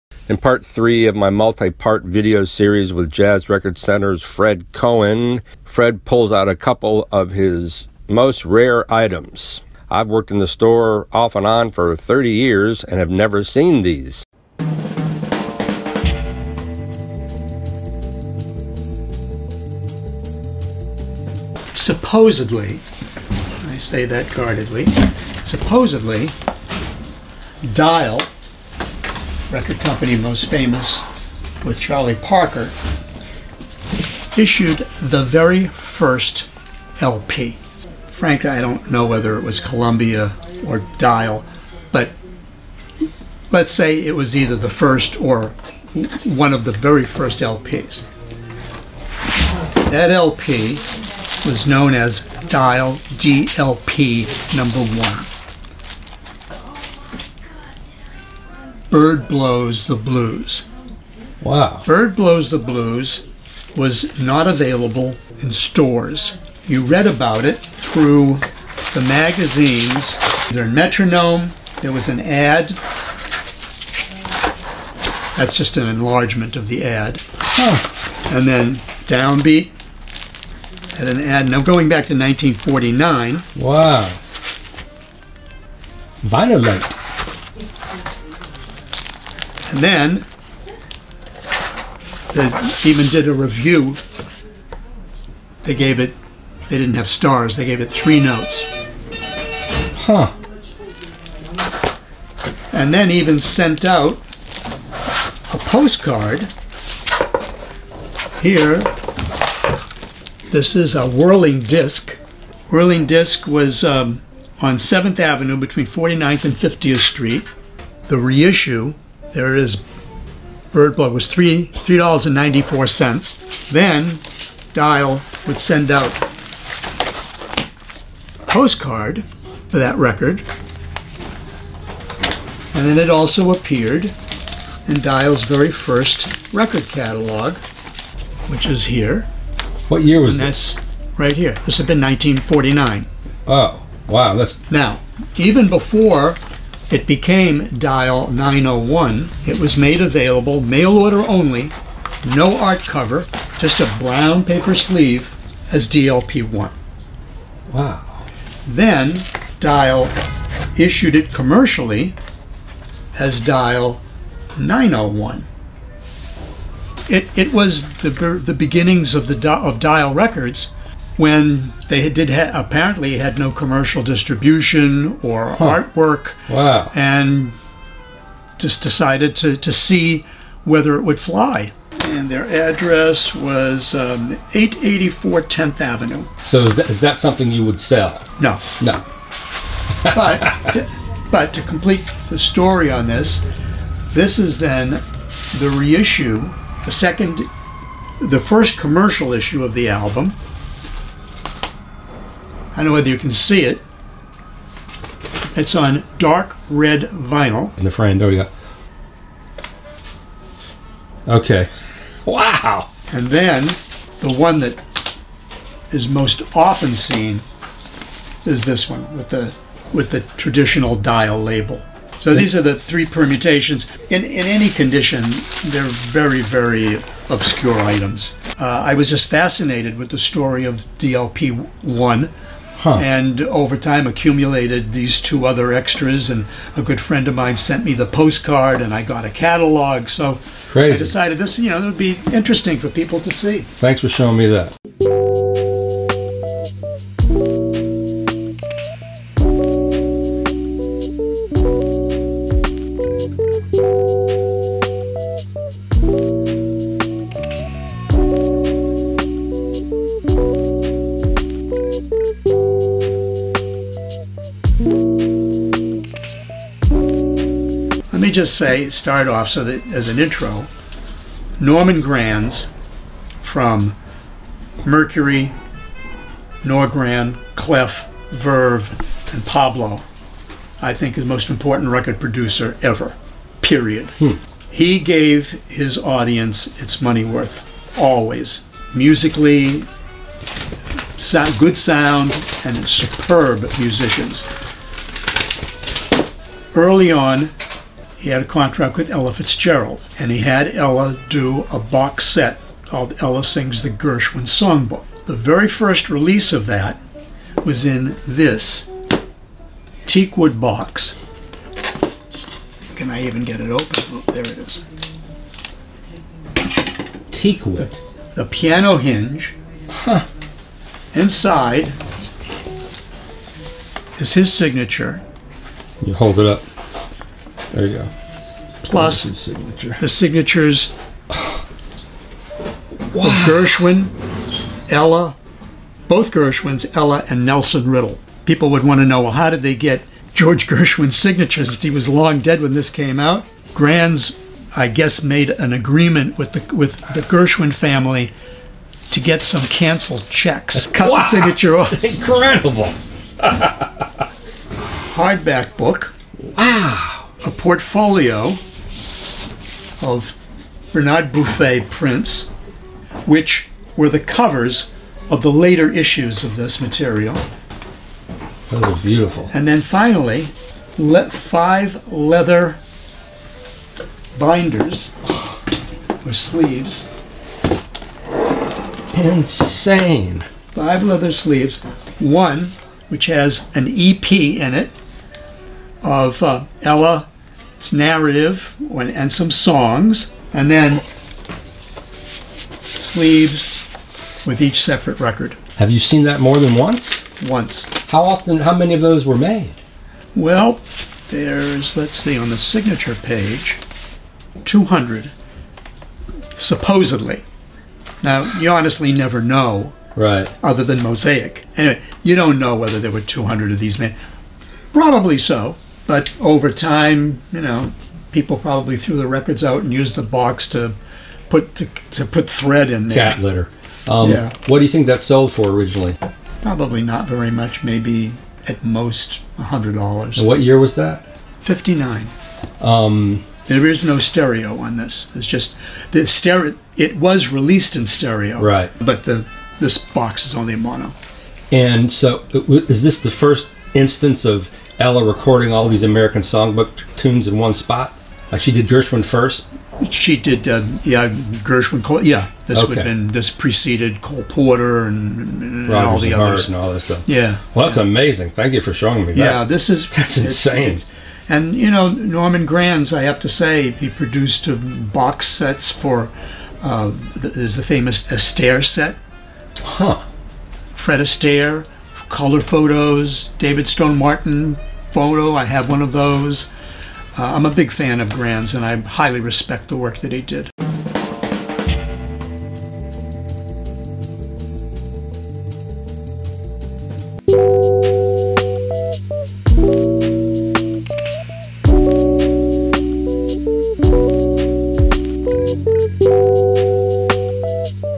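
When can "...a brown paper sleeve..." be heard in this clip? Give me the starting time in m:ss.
2:33.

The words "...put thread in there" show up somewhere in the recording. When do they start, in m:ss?
7:02.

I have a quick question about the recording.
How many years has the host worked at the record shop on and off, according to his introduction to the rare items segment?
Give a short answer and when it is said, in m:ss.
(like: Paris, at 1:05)
30 years, at 0:11.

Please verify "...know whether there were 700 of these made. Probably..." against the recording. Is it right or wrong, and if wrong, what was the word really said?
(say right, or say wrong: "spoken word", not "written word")
wrong: "200", not "700".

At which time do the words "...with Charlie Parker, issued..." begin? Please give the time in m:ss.
0:31.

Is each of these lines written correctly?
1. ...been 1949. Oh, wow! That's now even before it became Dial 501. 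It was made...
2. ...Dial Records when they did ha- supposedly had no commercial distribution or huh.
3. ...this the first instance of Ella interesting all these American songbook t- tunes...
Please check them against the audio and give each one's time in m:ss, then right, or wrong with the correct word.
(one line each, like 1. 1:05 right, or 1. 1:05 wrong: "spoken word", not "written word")
1. 2:21 wrong: "901", not "501"
2. 2:49 wrong: "apparently", not "supposedly"
3. 7:23 wrong: "recording", not "interesting".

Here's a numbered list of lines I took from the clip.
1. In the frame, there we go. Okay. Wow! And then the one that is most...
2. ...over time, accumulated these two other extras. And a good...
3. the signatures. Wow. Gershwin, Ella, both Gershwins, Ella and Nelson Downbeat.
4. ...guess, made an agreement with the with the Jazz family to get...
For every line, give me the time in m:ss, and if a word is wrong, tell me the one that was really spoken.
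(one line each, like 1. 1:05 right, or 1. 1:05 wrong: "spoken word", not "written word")
1. 3:27 right
2. 3:53 right
3. 5:30 wrong: "Riddle", not "Downbeat"
4. 5:44 wrong: "Gershwin", not "Jazz".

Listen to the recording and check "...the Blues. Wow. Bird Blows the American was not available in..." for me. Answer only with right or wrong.
wrong.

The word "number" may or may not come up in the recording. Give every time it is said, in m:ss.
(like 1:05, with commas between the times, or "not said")
0:54.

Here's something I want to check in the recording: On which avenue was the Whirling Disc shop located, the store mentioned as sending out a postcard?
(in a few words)
7th Avenue.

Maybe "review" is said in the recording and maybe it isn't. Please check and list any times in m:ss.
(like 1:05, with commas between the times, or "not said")
1:33.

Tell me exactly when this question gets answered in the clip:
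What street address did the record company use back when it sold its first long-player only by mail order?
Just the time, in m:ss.
3:04.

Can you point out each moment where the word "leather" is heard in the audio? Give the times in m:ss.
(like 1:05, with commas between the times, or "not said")
6:12, 6:21.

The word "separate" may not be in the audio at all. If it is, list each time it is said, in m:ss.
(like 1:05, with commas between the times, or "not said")
6:34.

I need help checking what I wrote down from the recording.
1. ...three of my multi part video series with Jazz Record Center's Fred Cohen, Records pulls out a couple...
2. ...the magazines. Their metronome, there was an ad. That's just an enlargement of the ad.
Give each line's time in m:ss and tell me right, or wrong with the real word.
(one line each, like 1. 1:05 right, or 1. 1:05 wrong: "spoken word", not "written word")
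1. 0:00 wrong: "Fred", not "Records"
2. 1:08 right.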